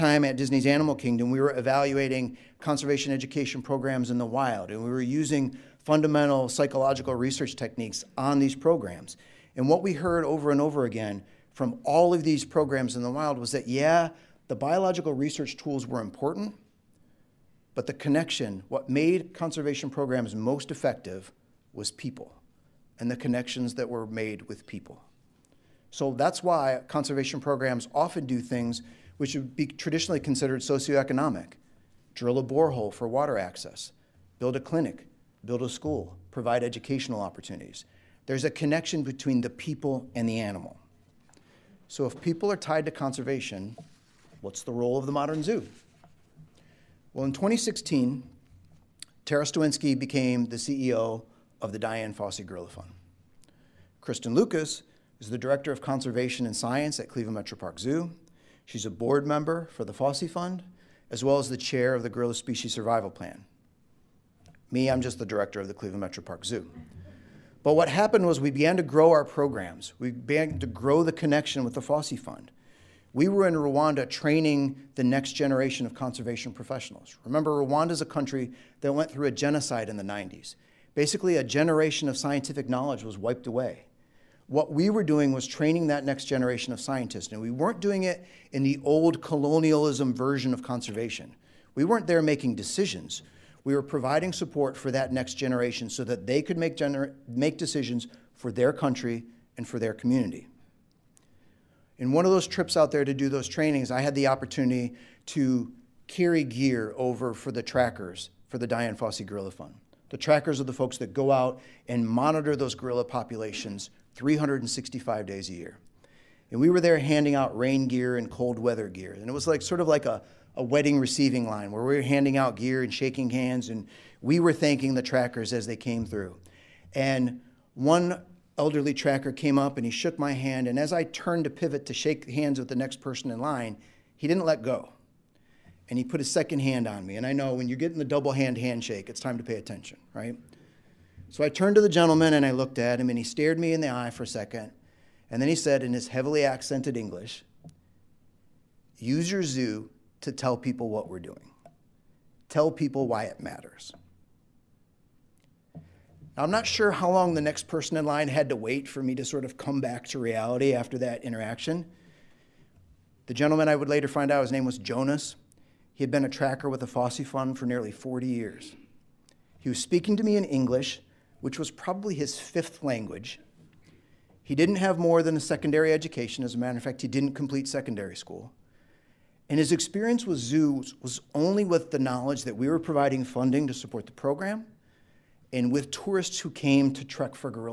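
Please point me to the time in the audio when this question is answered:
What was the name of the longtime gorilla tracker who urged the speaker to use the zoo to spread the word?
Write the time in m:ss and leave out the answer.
2:44.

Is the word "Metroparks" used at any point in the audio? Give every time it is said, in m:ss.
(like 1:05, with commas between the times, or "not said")
0:57, 1:06.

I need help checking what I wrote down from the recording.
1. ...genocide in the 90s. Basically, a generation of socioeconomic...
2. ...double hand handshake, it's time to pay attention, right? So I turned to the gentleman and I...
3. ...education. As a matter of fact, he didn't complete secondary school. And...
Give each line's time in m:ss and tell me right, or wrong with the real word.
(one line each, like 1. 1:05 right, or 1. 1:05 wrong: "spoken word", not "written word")
1. 1:19 wrong: "scientific", not "socioeconomic"
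2. 2:18 right
3. 2:55 right.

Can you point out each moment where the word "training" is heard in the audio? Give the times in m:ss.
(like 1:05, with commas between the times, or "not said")
1:14, 1:25, 1:43.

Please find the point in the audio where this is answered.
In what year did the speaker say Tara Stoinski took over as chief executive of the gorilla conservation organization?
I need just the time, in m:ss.
0:47.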